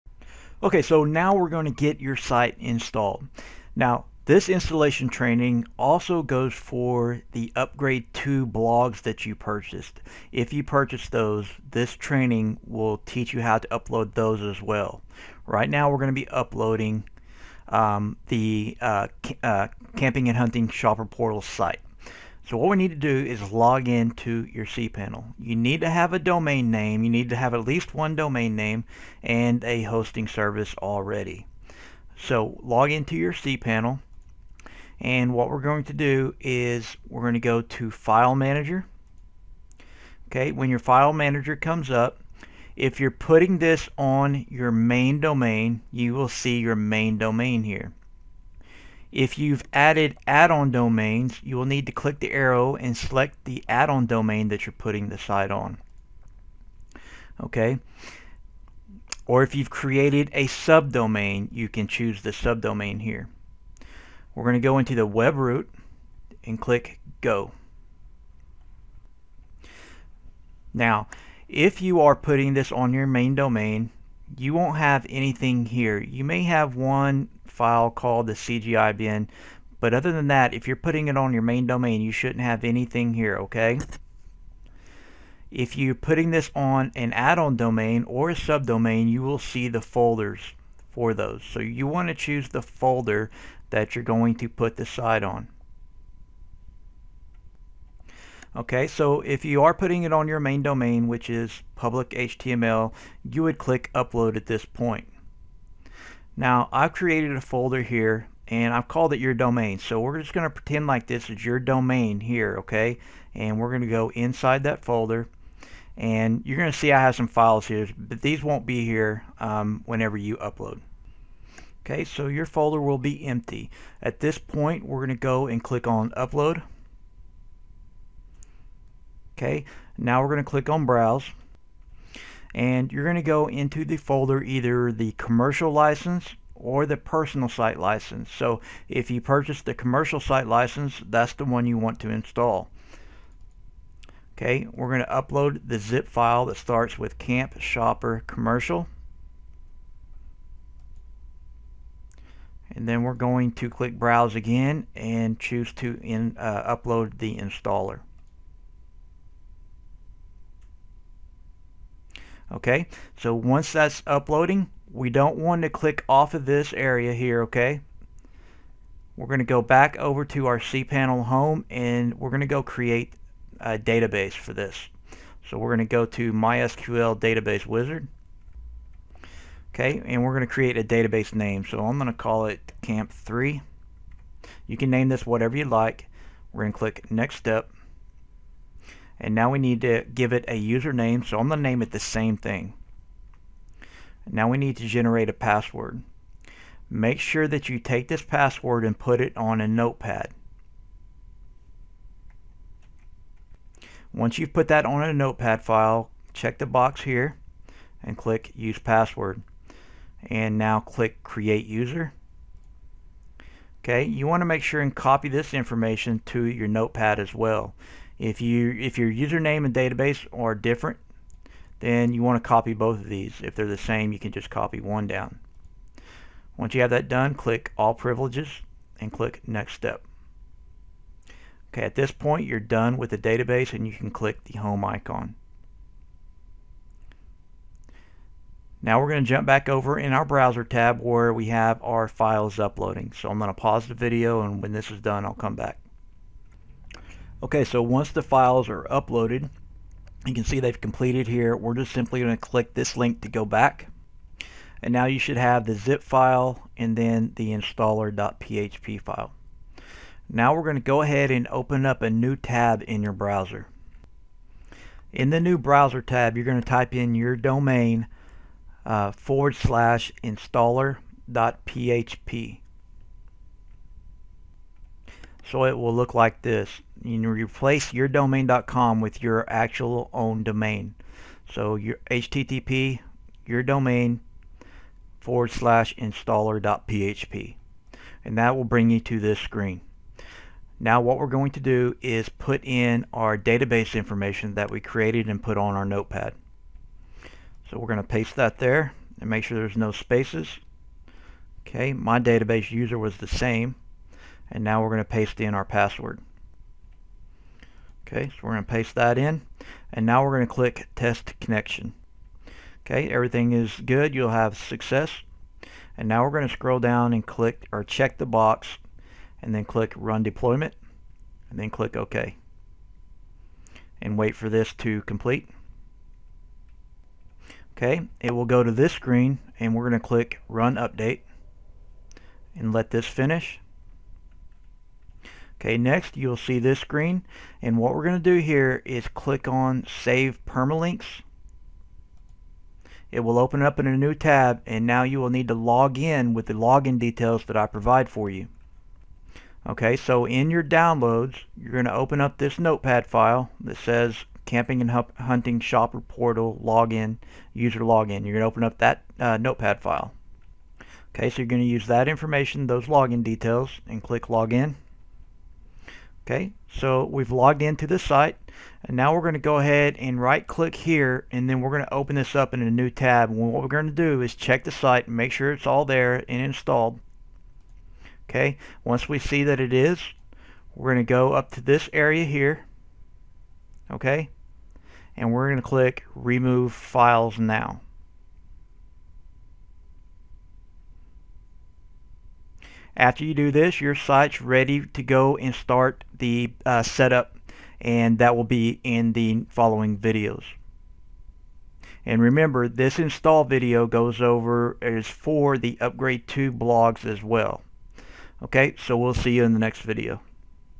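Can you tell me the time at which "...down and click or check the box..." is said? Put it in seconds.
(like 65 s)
316 s.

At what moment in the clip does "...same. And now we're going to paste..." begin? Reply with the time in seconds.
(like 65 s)
303 s.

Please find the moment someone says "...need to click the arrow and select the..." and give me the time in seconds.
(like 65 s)
51 s.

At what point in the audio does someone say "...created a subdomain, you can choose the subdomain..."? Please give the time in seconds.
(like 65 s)
59 s.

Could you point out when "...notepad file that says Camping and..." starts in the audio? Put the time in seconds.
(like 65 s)
352 s.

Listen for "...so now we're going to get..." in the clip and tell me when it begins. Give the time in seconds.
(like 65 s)
0 s.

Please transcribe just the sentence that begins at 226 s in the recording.
Once you have that done, click All Privileges and click Next Step.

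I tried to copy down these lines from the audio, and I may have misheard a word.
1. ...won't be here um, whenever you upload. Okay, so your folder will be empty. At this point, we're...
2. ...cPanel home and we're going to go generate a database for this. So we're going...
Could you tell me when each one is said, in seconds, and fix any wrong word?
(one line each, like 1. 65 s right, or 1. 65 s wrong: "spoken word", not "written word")
1. 118 s right
2. 170 s wrong: "create", not "generate".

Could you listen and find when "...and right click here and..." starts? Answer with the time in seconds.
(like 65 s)
369 s.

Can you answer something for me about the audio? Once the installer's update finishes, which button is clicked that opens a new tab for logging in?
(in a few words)
Save Permalinks.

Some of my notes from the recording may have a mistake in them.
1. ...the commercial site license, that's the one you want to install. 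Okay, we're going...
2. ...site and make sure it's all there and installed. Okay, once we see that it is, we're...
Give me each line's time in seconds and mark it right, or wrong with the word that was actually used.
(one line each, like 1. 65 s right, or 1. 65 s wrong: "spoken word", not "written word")
1. 139 s right
2. 374 s right.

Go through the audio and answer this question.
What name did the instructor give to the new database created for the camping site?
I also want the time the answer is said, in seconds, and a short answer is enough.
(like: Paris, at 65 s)
Camp3, at 182 s.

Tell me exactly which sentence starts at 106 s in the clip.
Now I've created a folder here and I've called it your domain.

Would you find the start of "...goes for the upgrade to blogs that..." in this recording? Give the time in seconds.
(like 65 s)
6 s.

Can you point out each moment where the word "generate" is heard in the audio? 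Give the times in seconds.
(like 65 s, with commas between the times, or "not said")
194 s.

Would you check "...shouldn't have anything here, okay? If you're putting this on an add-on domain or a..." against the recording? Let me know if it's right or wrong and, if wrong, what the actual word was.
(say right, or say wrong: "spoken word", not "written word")
right.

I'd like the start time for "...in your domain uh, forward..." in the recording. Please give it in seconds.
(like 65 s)
266 s.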